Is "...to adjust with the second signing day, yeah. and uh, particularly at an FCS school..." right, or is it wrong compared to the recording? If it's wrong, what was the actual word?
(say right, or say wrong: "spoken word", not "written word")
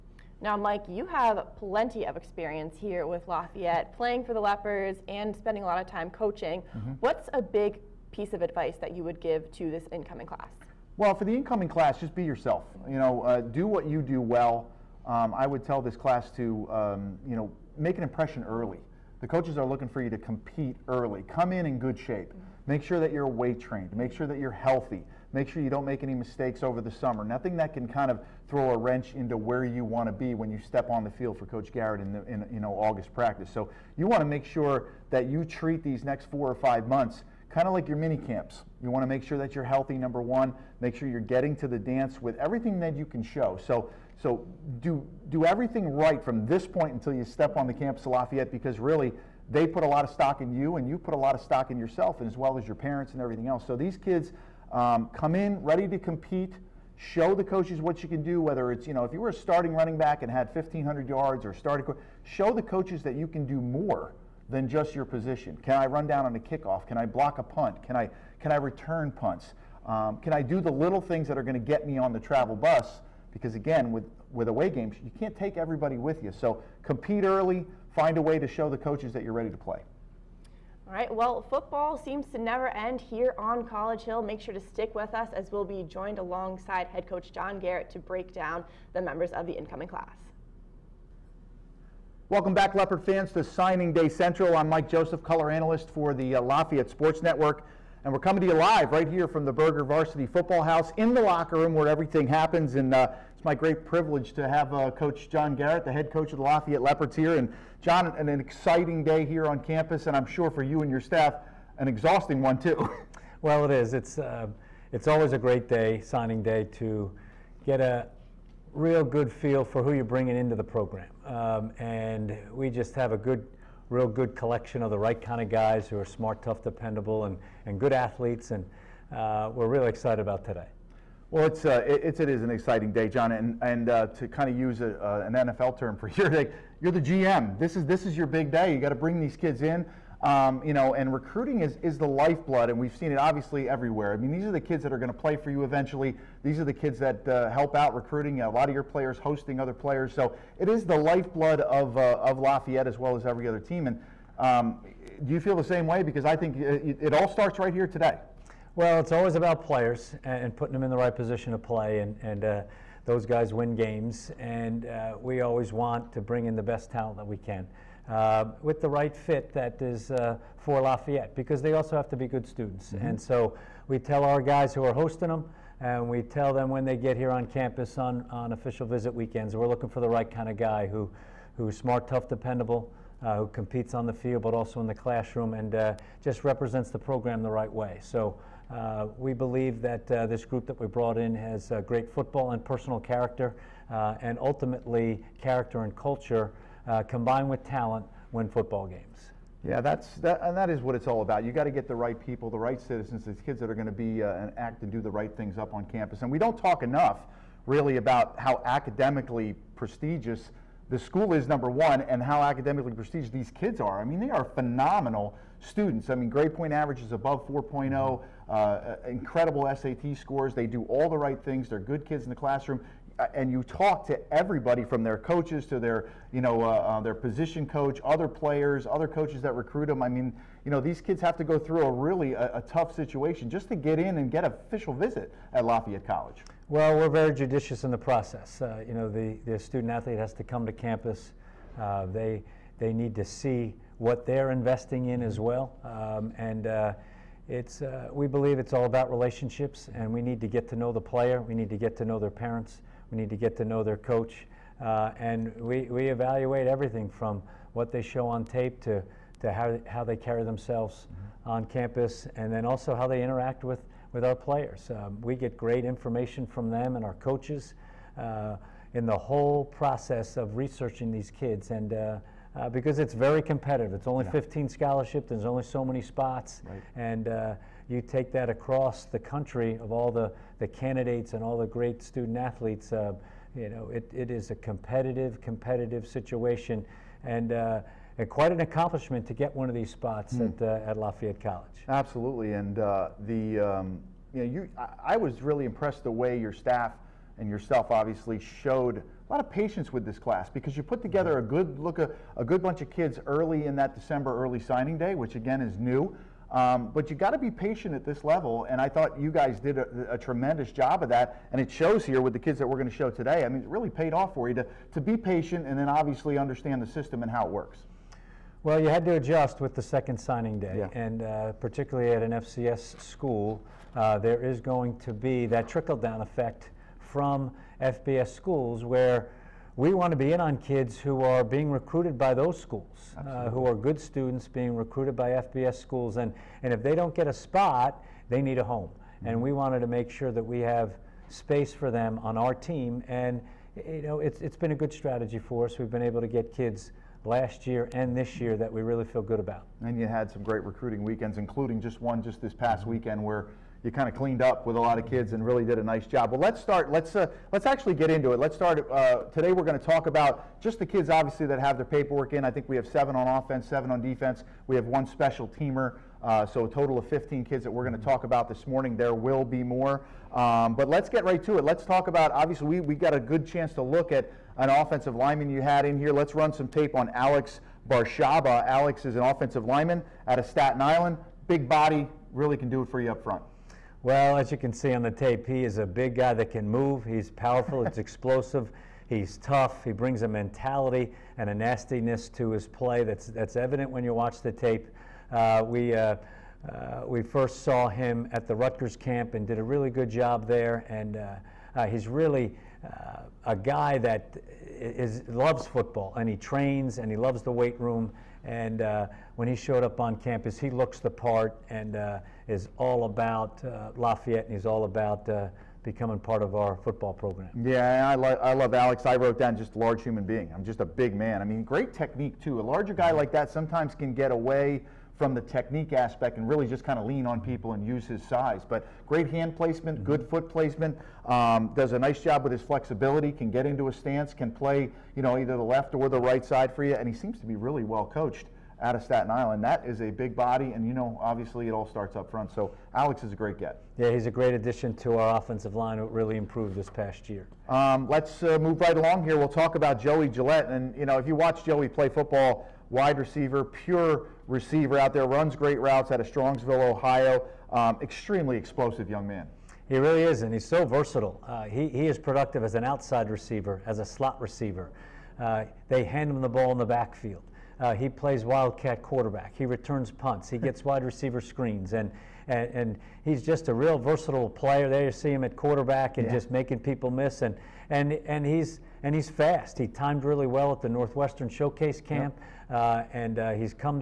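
right.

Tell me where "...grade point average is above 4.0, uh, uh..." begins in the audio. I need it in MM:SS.
03:36.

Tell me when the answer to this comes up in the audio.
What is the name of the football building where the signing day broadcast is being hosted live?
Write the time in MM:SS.
01:39.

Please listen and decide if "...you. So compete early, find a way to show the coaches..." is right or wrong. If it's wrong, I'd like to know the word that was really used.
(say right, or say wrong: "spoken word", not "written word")
right.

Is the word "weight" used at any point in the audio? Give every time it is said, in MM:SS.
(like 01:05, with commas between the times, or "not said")
00:23, 06:47.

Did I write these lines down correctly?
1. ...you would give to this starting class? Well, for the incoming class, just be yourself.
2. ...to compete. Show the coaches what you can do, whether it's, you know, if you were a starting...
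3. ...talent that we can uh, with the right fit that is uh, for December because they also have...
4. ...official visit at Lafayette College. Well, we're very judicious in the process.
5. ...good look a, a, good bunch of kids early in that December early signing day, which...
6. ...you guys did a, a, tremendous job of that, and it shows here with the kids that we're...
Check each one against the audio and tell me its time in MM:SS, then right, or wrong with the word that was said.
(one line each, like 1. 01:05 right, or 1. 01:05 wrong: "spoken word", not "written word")
1. 00:08 wrong: "incoming", not "starting"
2. 00:55 right
3. 02:46 wrong: "Lafayette", not "December"
4. 03:54 right
5. 05:01 right
6. 05:09 right.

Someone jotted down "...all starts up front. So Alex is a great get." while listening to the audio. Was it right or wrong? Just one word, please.
right.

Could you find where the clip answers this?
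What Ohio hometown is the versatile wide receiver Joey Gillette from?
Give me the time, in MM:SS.
07:36.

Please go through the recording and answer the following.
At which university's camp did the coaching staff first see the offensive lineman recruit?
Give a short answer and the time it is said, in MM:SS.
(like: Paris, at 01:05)
Rutgers, at 06:38.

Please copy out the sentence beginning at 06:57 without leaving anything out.
Yeah, I, lo I love Alex.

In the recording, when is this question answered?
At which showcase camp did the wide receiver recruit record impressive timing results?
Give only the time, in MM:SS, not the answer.
08:00.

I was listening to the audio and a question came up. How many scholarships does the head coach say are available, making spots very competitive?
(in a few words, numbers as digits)
15.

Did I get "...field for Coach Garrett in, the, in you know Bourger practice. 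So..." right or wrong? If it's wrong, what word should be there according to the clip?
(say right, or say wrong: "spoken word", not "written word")
wrong: "August", not "Bourger".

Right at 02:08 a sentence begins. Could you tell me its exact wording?
And uh, we're really excited about today.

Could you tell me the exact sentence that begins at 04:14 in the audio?
Uh, and we, we evaluate everything from what they show on tape to, to how, how they carry themselves mm -hmm.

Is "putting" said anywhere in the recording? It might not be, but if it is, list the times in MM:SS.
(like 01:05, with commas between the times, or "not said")
02:40.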